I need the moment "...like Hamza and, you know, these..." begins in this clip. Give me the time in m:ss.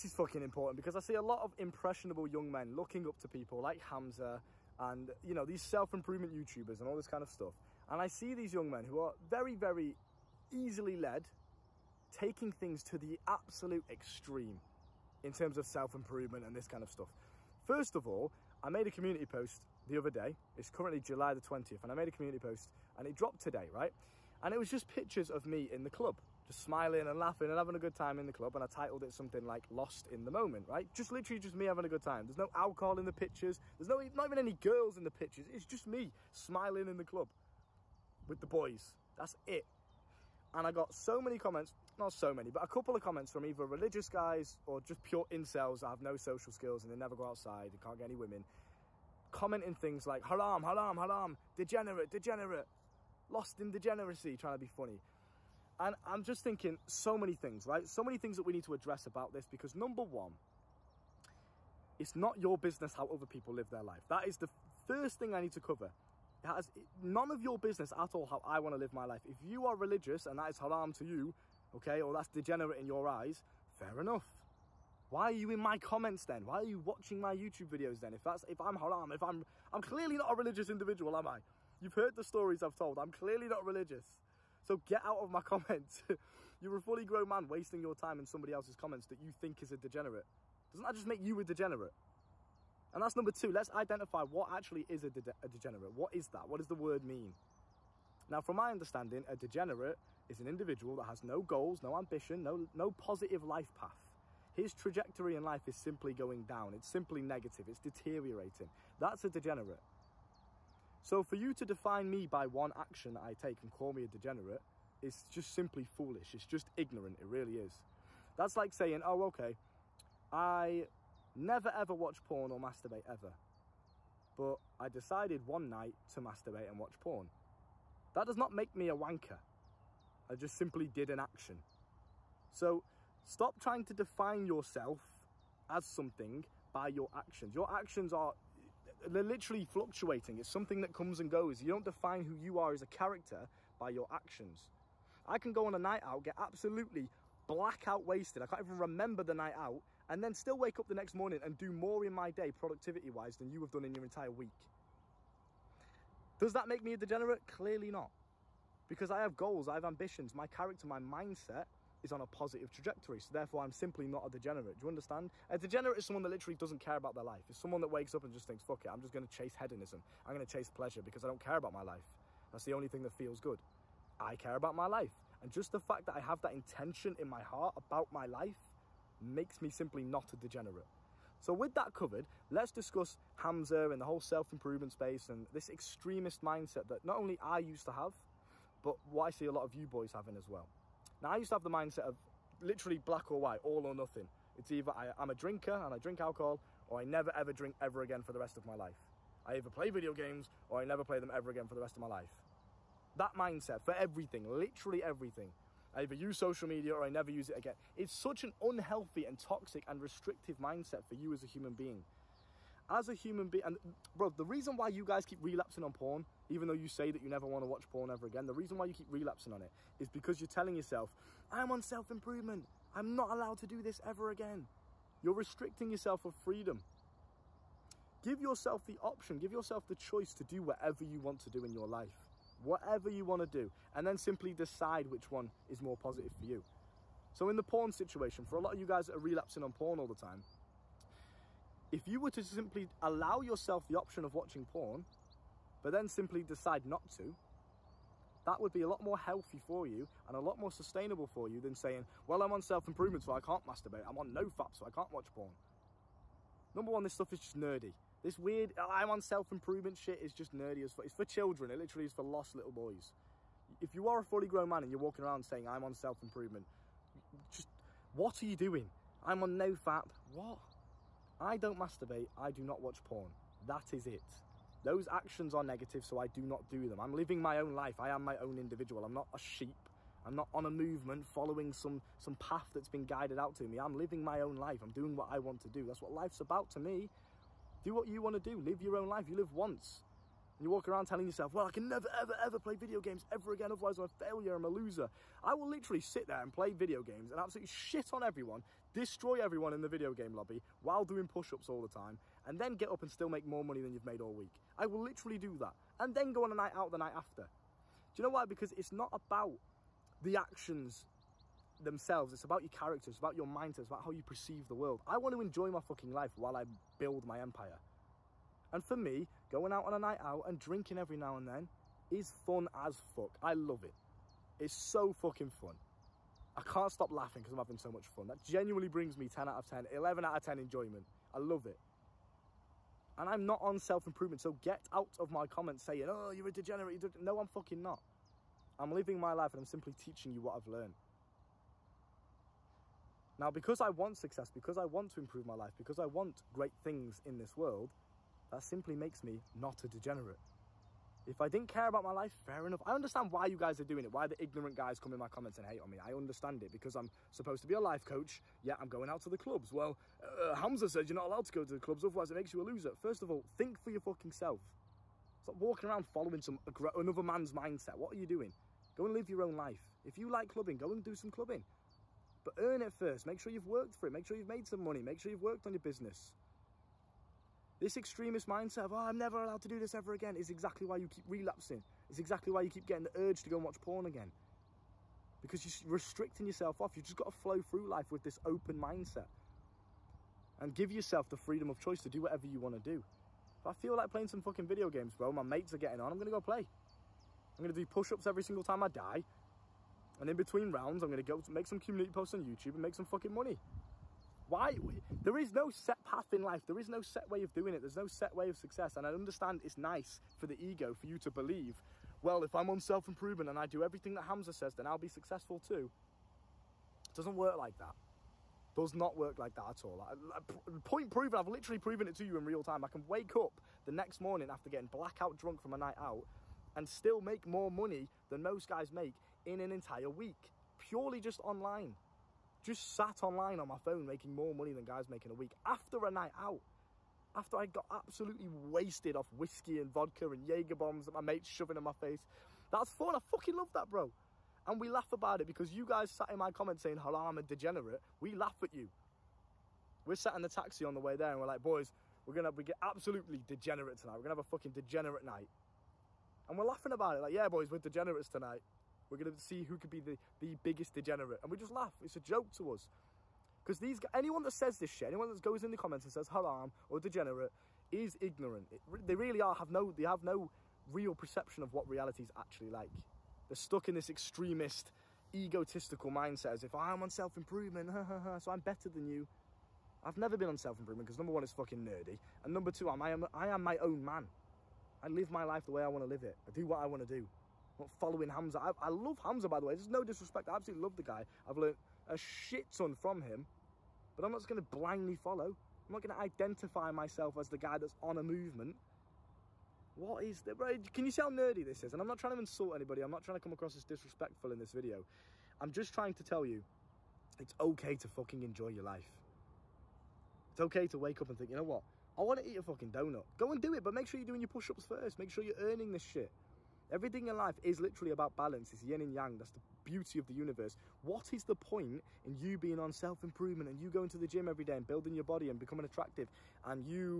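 0:03.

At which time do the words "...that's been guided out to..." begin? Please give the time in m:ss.
4:42.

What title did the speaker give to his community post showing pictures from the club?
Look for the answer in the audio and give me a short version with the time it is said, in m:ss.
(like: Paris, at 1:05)
Lost in the Moment, at 0:29.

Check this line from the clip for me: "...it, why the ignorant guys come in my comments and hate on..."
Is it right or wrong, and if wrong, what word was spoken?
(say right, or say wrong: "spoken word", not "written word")
right.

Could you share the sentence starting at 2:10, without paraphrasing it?
I just simply did an action.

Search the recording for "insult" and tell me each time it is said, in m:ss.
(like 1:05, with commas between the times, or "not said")
8:22.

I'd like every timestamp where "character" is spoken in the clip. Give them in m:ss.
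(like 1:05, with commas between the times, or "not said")
2:22, 2:40, 5:12.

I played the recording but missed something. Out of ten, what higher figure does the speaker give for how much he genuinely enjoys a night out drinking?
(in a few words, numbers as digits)
11.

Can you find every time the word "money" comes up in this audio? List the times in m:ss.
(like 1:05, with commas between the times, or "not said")
5:03, 6:14, 6:43, 7:07, 7:14.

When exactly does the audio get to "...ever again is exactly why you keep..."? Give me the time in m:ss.
6:19.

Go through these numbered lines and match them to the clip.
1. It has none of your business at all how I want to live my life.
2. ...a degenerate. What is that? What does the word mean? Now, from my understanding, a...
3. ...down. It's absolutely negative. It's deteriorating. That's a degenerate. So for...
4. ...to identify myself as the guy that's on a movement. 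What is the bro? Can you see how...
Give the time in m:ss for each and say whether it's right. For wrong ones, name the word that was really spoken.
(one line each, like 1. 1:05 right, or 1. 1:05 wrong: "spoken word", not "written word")
1. 1:06 right
2. 1:35 right
3. 1:46 wrong: "simply", not "absolutely"
4. 8:16 right.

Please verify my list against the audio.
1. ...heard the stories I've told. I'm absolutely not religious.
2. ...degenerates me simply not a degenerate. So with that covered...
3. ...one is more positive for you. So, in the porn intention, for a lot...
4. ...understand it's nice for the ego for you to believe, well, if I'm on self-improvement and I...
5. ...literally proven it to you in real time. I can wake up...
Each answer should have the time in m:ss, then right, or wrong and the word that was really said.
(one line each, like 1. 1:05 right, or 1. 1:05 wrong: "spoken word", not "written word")
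1. 1:21 wrong: "clearly", not "absolutely"
2. 2:59 wrong: "makes", not "degenerates"
3. 3:55 wrong: "situation", not "intention"
4. 6:49 right
5. 7:01 right.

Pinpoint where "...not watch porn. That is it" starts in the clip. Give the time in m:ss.
4:32.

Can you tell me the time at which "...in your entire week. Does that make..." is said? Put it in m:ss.
2:33.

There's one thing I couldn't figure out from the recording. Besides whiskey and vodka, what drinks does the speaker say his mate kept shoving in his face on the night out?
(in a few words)
Jaeger bombs.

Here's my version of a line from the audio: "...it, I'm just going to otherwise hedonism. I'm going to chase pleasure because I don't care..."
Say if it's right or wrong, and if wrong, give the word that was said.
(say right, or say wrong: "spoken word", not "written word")
wrong: "chase", not "otherwise".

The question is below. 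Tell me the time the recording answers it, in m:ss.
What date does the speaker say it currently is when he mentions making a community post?
0:21.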